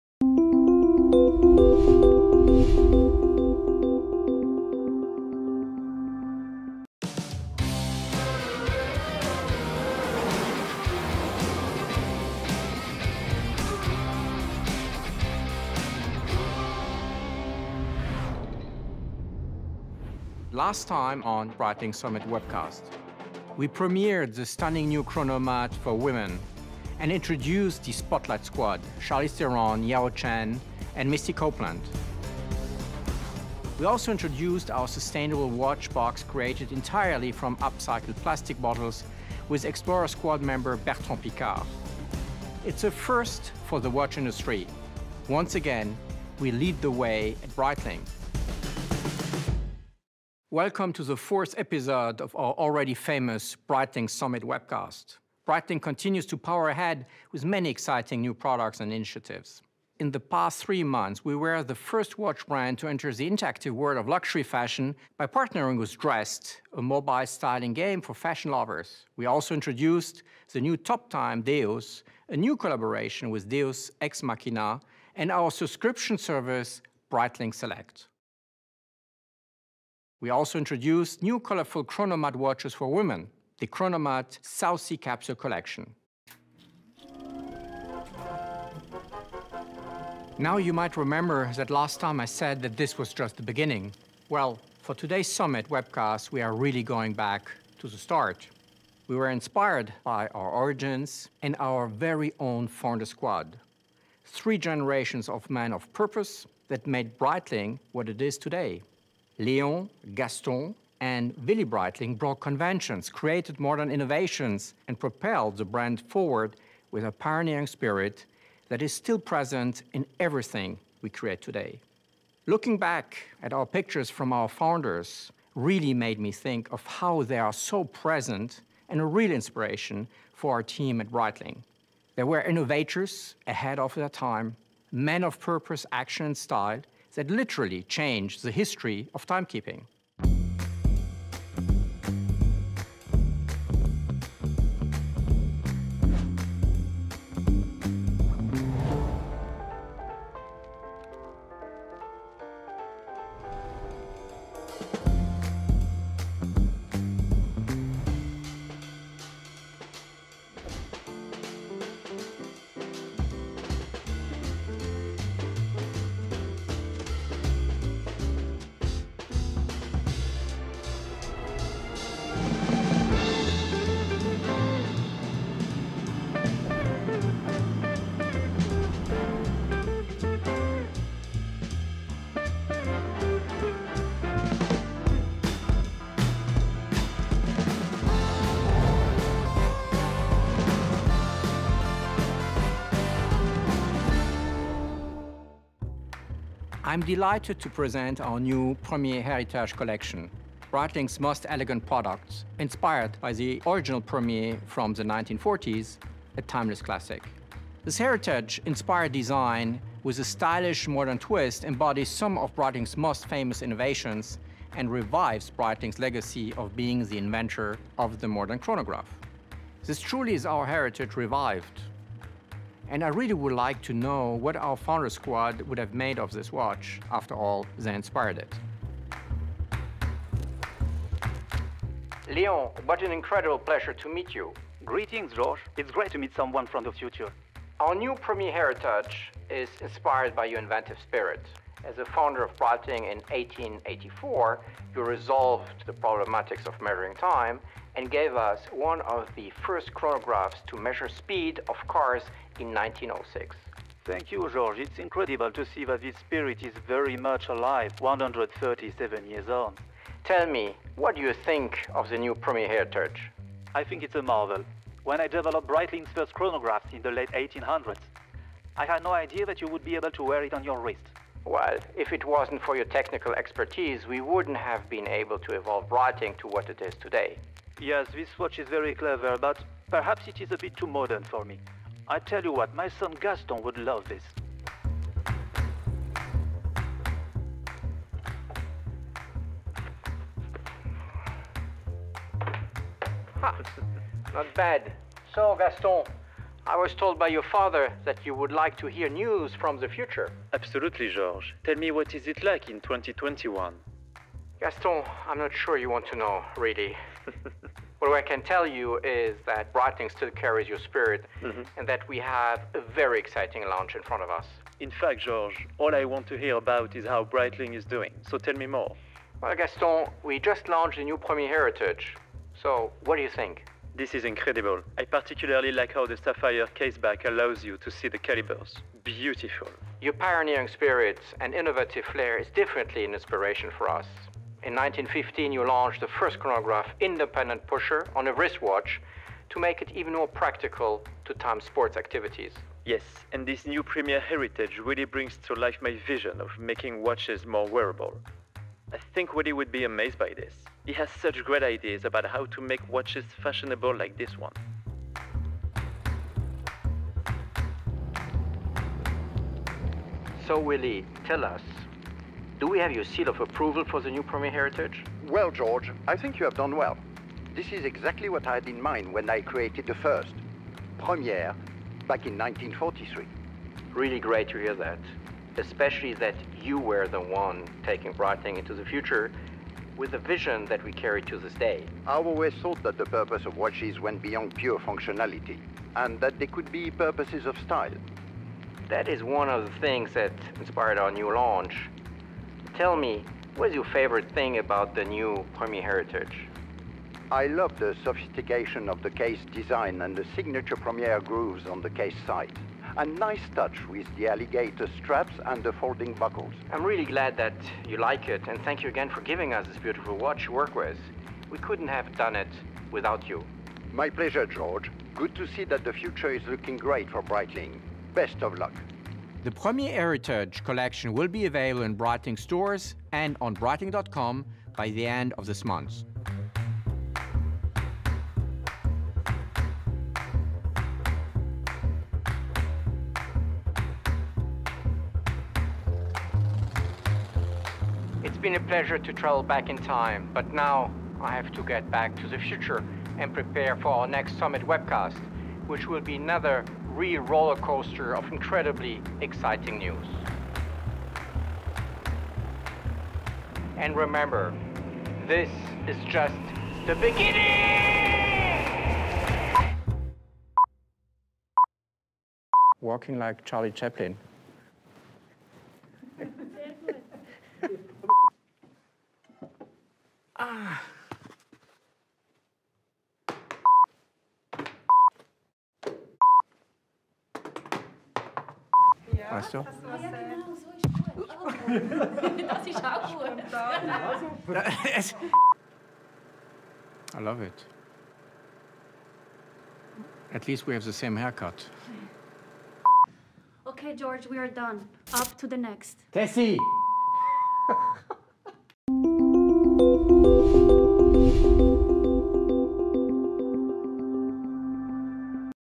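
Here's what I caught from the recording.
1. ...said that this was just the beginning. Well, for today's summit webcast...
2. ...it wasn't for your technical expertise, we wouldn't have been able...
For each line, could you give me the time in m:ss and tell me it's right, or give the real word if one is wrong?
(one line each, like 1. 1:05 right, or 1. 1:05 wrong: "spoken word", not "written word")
1. 1:32 right
2. 4:32 right.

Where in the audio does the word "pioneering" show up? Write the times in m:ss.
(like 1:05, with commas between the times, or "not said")
1:57, 5:30.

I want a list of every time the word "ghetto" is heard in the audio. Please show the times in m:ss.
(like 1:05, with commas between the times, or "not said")
not said.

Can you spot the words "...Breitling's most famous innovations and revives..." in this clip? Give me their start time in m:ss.
3:32.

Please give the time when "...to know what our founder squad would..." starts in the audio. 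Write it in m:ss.
3:43.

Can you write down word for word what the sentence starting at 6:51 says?
We couldn't have done it without you.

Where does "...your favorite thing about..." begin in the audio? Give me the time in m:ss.
6:33.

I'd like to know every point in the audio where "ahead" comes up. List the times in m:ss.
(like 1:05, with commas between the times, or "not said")
0:56, 2:13.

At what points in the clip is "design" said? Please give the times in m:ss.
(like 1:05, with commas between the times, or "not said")
3:29, 6:39.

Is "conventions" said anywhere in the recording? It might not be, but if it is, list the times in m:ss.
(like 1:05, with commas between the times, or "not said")
1:52.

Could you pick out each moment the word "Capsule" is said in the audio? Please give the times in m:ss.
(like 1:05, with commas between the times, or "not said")
1:24.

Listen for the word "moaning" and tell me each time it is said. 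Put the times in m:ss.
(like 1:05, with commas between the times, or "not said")
not said.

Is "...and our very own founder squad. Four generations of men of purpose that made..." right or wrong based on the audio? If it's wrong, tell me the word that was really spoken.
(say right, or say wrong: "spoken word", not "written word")
wrong: "Three", not "Four".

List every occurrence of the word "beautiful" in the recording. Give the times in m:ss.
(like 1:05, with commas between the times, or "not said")
5:29, 6:49.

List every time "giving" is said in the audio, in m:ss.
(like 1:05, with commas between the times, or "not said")
6:49.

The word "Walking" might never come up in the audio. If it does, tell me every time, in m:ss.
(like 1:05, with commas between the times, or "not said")
7:42.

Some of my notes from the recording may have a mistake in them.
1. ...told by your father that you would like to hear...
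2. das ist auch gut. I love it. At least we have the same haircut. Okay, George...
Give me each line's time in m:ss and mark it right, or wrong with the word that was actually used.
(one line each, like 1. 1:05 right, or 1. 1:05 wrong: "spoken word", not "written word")
1. 4:56 right
2. 8:02 right.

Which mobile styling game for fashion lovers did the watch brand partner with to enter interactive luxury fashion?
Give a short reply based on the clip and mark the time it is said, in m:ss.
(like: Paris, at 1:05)
Drest, at 1:05.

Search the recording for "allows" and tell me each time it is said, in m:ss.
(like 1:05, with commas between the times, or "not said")
5:27.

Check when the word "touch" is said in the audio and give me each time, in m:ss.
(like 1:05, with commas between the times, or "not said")
6:43.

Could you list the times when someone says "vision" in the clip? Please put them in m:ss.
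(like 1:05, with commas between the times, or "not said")
5:46, 6:20.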